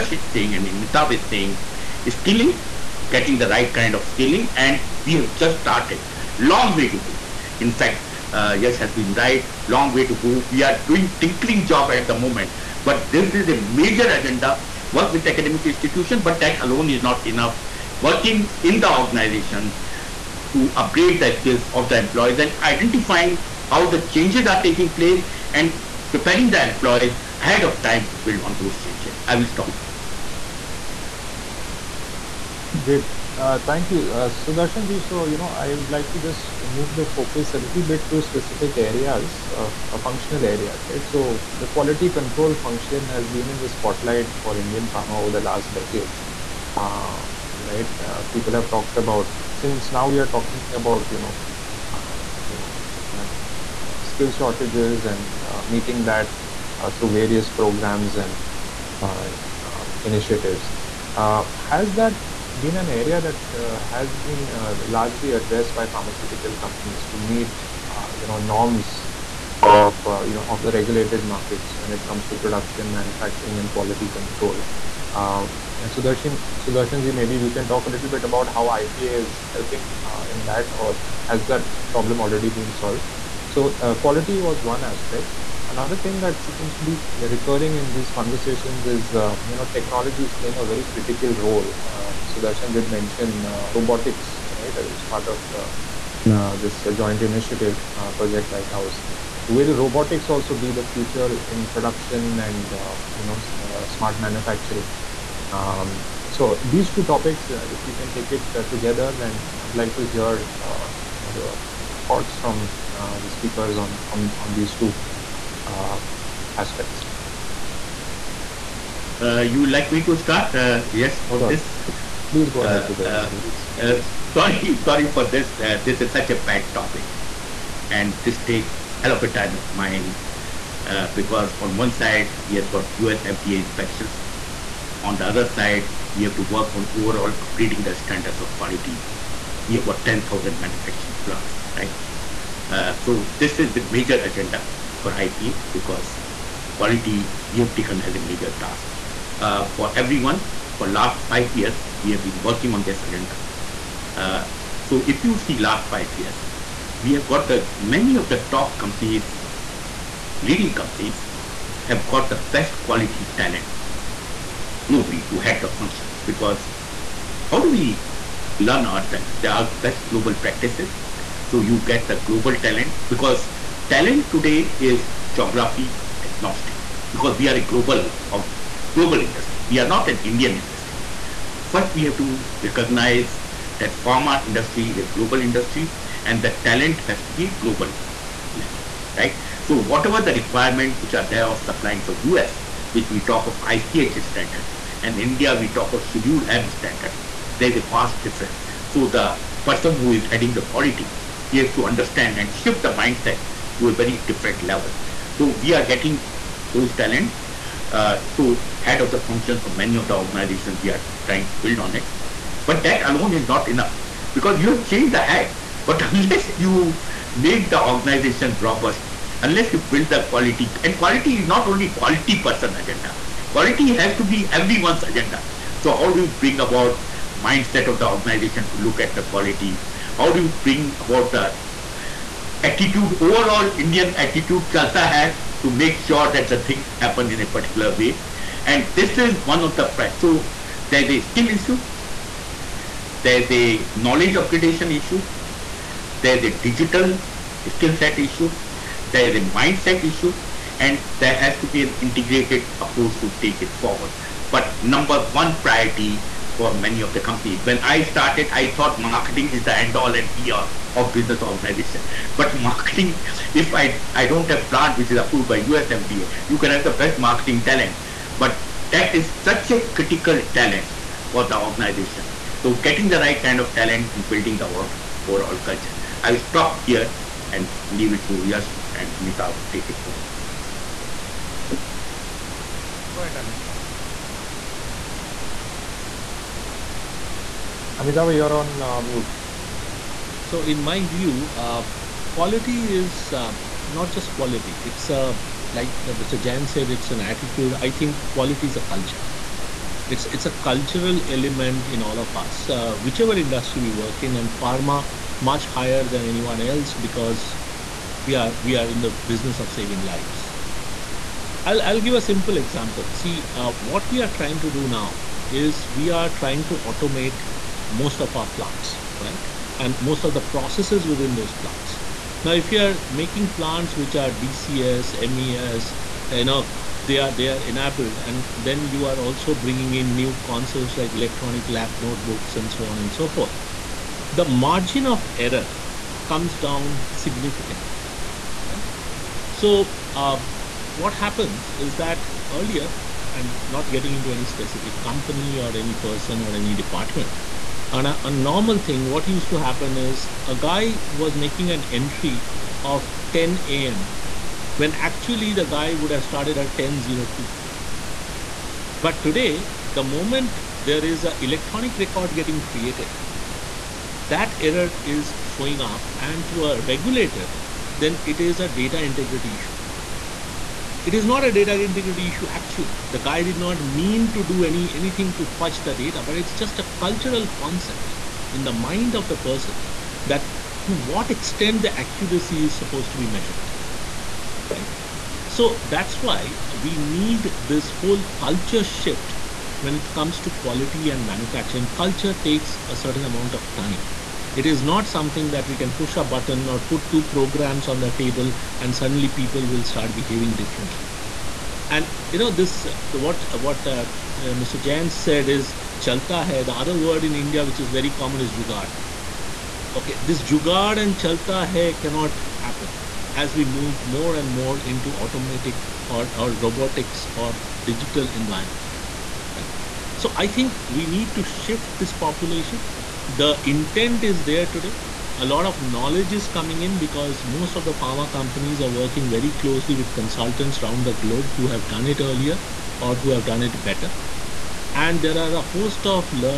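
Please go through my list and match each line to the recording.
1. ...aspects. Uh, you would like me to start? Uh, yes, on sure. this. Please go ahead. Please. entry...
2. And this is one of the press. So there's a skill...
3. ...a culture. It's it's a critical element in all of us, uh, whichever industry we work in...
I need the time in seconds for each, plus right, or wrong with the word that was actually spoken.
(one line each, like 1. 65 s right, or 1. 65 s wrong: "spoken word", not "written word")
1. 116 s wrong: "sorry", not "entry"
2. 238 s right
3. 298 s wrong: "cultural", not "critical".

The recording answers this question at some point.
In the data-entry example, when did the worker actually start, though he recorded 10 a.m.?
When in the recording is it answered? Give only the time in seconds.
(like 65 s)
356 s.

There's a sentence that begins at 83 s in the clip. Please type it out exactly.
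So, uh, quality was one aspect.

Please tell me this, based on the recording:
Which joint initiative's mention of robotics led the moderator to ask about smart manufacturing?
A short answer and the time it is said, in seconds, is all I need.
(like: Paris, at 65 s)
Project Lighthouse, at 98 s.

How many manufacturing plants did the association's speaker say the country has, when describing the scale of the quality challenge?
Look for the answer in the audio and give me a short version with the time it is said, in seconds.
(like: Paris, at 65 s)
10,000, at 140 s.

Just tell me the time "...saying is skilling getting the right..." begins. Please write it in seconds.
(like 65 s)
1 s.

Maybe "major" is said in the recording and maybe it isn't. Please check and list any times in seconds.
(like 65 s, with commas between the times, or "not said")
13 s, 143 s, 148 s.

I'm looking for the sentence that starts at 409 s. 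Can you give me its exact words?
Okay, this jugaad and chalta hai cannot happen as we move more and more into automatic or, or robotics or digital environment.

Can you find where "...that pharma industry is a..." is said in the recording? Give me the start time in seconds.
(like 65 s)
183 s.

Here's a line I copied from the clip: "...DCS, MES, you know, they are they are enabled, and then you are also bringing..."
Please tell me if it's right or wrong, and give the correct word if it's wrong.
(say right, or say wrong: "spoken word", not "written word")
right.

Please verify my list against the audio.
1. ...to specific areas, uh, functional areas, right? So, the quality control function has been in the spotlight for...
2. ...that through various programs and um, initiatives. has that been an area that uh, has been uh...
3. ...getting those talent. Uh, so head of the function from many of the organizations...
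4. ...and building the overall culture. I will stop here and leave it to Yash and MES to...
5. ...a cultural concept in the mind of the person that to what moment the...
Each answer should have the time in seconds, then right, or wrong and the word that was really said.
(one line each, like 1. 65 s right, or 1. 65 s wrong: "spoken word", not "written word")
1. 38 s right
2. 56 s right
3. 205 s right
4. 274 s wrong: "Amitava", not "MES"
5. 376 s wrong: "extent", not "moment".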